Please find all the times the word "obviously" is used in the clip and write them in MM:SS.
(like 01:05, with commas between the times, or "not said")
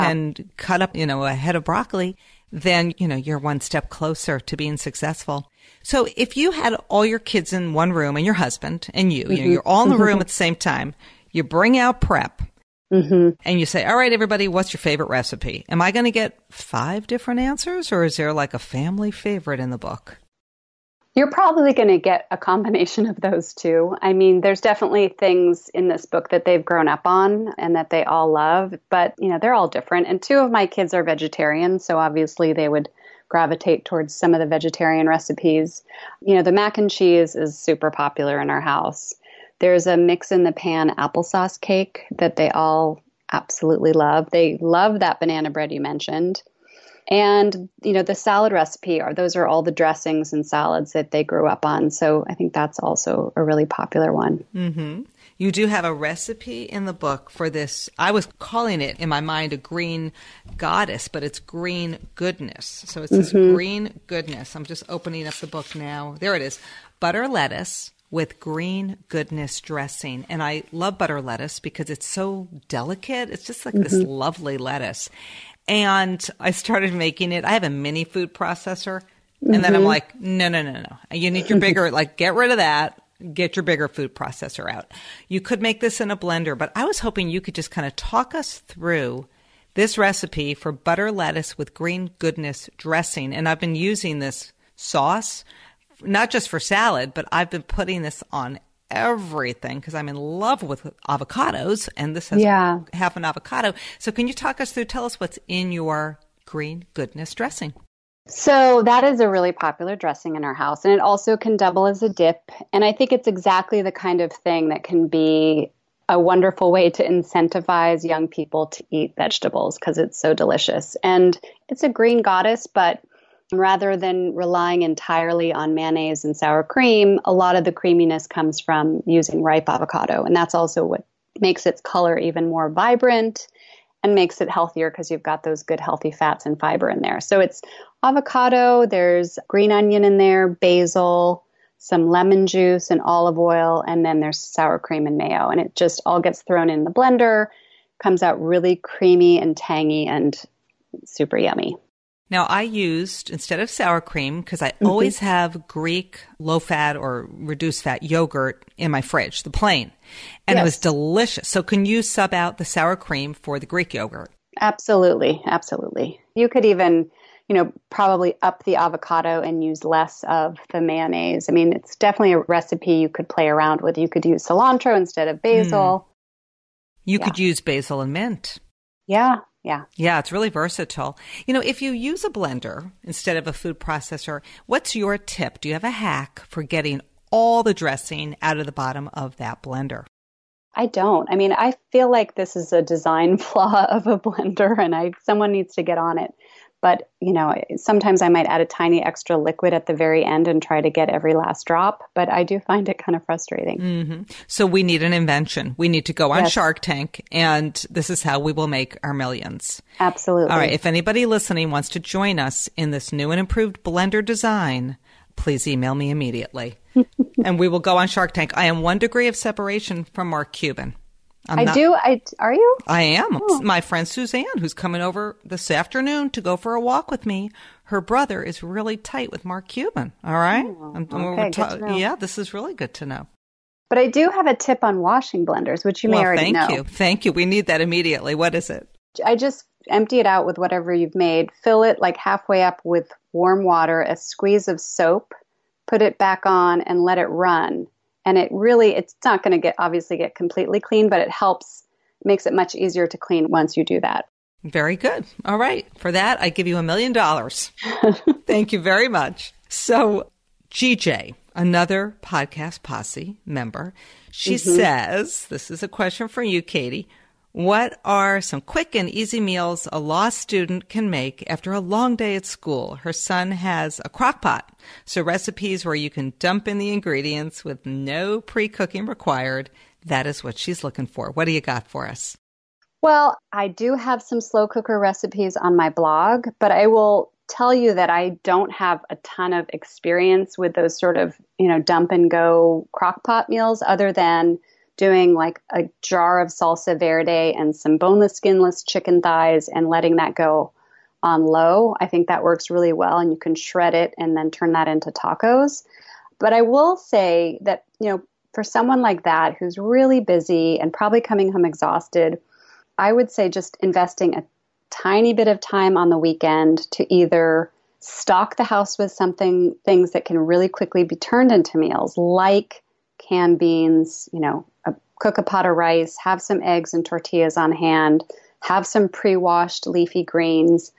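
00:31, 04:09.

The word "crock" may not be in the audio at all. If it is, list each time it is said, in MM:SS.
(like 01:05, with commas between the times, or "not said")
04:34, 04:52.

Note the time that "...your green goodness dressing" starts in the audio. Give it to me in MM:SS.
01:45.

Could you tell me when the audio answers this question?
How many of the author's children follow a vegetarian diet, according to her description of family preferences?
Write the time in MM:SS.
00:30.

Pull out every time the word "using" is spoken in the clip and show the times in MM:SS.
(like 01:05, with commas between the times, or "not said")
01:33, 02:09.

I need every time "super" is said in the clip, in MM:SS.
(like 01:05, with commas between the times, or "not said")
00:37, 02:31.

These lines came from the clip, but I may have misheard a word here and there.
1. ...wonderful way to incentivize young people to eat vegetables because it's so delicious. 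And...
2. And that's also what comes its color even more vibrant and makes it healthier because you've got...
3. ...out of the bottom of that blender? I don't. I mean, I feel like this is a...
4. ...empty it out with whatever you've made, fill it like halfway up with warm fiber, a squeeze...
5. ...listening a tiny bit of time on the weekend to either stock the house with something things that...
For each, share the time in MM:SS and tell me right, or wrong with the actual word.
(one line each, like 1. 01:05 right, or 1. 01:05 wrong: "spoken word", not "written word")
1. 01:56 right
2. 02:10 wrong: "makes", not "comes"
3. 03:08 right
4. 03:59 wrong: "water", not "fiber"
5. 05:13 wrong: "investing", not "listening".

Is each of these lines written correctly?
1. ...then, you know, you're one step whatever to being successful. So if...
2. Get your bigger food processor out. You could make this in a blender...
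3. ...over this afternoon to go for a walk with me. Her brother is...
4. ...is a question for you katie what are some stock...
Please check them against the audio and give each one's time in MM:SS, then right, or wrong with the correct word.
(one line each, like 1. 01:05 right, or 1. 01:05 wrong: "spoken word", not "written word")
1. 00:02 wrong: "closer", not "whatever"
2. 01:23 right
3. 03:45 right
4. 04:25 wrong: "quick", not "stock".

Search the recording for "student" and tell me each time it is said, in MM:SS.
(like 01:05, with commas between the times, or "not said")
04:30.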